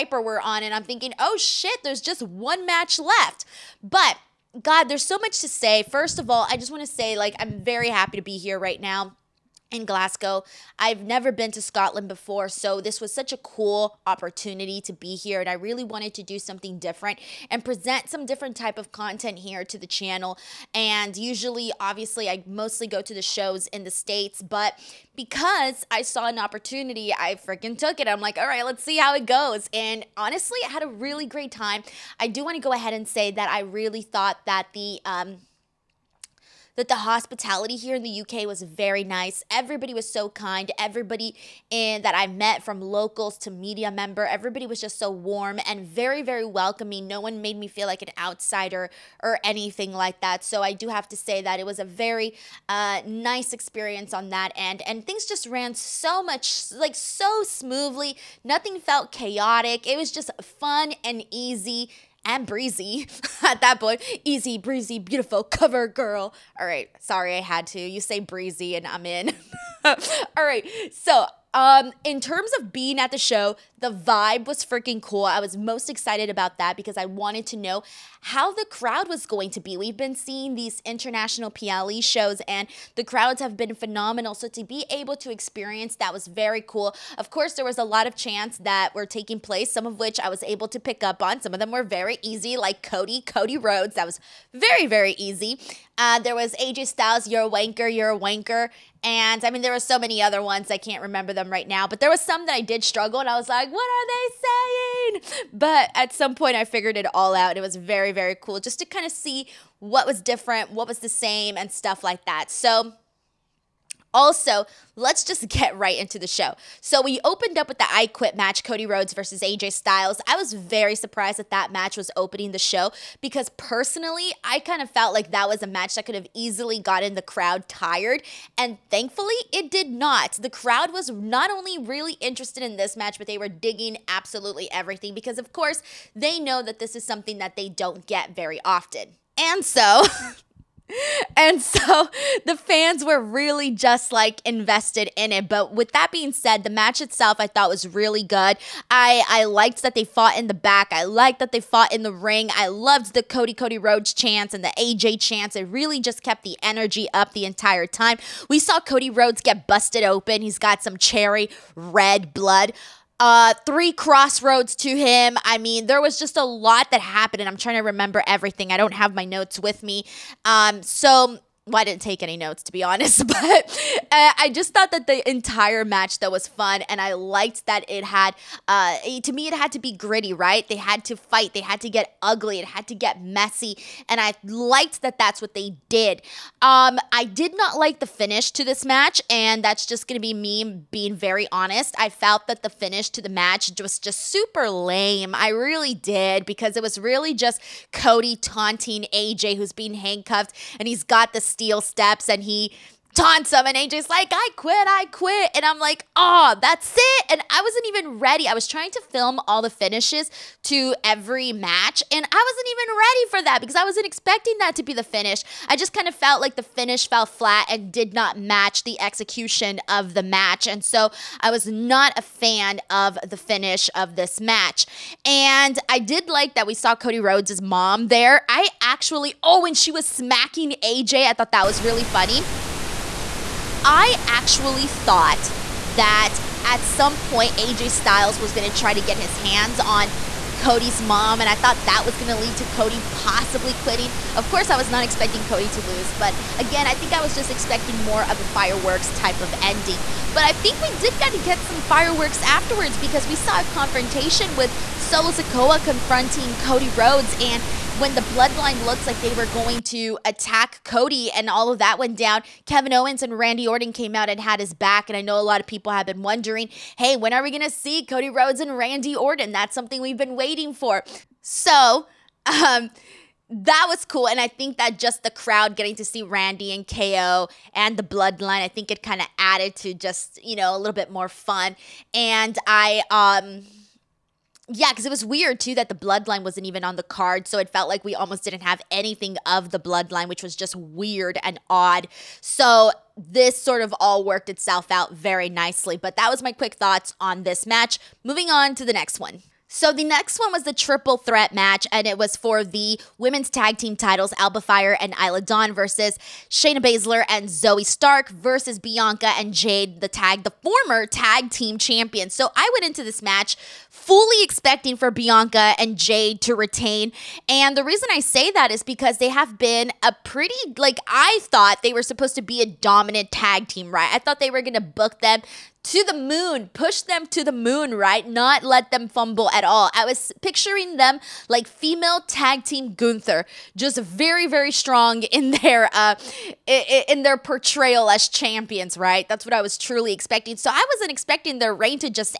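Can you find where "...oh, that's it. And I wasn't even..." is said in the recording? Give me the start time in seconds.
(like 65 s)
206 s.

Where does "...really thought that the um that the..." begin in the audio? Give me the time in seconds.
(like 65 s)
33 s.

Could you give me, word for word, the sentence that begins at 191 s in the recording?
I felt that the finish to the match was just super lame.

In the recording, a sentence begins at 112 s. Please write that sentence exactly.
So, also, let's just get right into the show.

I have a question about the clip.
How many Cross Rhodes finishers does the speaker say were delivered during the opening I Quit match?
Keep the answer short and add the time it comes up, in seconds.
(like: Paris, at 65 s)
3, at 163 s.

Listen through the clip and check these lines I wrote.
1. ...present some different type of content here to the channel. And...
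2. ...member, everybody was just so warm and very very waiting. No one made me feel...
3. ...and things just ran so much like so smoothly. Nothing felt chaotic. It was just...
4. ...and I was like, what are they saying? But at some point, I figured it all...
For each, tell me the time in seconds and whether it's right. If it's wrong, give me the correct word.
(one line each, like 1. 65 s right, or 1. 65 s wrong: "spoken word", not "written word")
1. 17 s right
2. 43 s wrong: "welcoming", not "waiting"
3. 54 s right
4. 103 s right.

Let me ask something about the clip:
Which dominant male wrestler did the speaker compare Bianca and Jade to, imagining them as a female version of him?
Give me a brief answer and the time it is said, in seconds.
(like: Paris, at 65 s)
Gunther, at 332 s.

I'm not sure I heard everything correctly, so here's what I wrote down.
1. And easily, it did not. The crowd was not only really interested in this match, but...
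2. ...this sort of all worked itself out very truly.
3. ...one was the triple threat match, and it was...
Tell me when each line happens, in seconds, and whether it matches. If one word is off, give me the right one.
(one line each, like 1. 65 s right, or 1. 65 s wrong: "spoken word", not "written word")
1. 128 s wrong: "thankfully", not "easily"
2. 293 s wrong: "nicely", not "truly"
3. 300 s right.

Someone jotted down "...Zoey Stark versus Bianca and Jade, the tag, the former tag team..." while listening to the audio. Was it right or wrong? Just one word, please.
right.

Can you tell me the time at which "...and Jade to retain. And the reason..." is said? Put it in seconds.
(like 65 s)
315 s.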